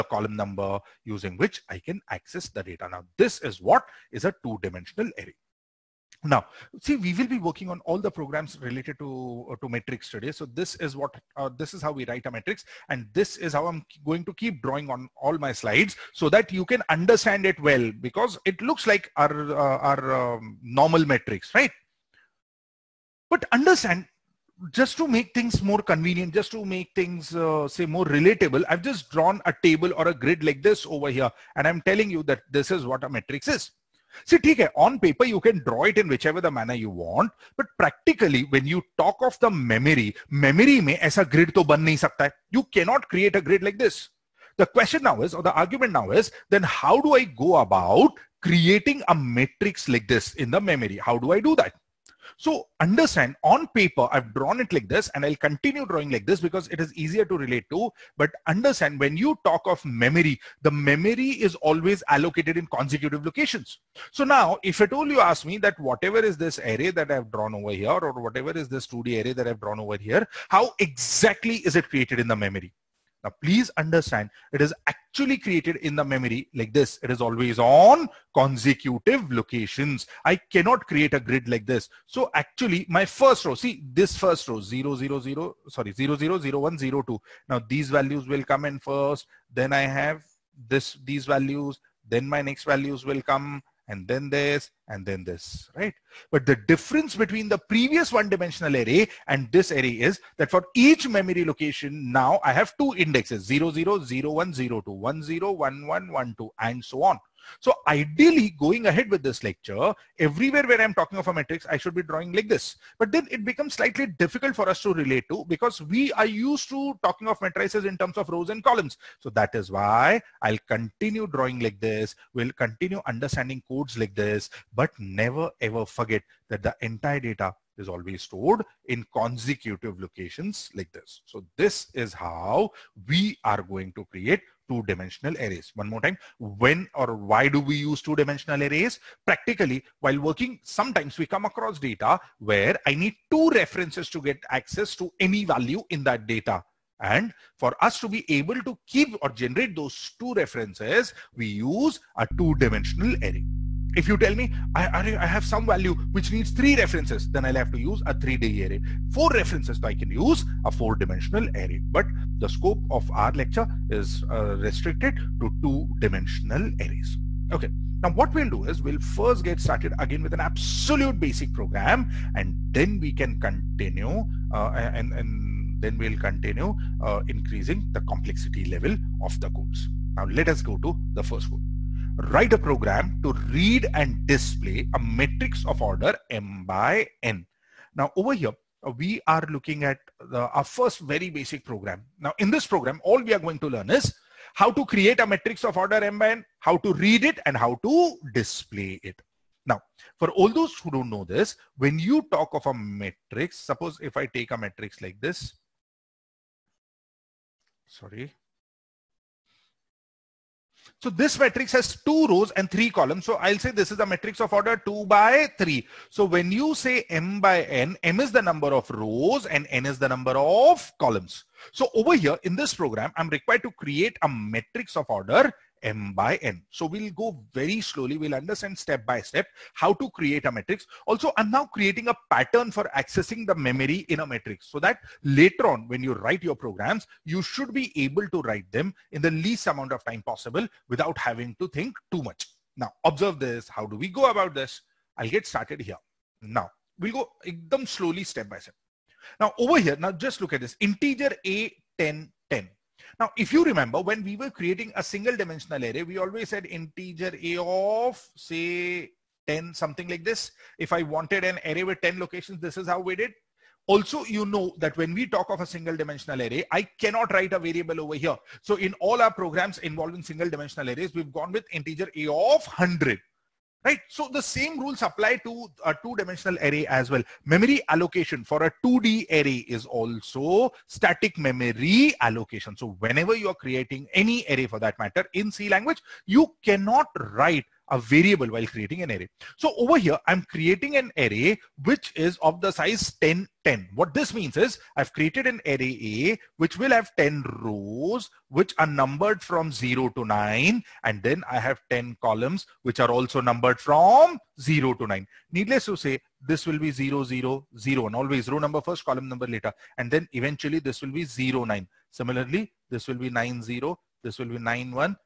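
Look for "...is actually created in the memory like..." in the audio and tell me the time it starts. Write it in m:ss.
1:14.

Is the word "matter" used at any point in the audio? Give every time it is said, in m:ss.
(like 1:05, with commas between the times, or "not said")
4:44.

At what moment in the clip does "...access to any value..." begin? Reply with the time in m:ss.
2:24.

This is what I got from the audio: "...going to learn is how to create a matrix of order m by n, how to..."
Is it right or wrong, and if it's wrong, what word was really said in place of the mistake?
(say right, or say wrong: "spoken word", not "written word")
right.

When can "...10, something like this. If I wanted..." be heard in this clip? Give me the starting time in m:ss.
4:19.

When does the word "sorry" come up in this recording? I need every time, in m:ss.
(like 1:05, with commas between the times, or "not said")
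1:25, 3:27.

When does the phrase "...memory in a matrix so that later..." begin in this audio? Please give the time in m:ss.
3:53.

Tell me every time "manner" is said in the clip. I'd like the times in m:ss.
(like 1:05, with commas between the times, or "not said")
0:36.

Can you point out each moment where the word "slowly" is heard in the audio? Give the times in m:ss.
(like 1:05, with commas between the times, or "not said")
3:47, 4:07.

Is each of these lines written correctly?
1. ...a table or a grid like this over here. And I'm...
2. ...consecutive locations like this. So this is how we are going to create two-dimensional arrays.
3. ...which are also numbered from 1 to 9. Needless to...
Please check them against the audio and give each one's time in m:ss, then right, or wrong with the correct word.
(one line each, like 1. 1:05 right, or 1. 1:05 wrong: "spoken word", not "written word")
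1. 0:29 right
2. 2:09 right
3. 5:02 wrong: "0", not "1".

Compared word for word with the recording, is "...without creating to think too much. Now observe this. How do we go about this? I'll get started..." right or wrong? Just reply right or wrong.
wrong.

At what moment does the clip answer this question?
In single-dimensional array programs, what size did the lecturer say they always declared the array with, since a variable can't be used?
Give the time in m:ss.
4:32.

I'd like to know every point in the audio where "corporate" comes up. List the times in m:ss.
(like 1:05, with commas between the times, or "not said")
not said.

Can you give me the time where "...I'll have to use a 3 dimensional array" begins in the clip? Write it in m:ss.
2:37.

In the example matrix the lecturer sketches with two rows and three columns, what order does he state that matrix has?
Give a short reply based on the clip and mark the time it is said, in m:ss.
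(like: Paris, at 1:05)
2 by 3, at 3:34.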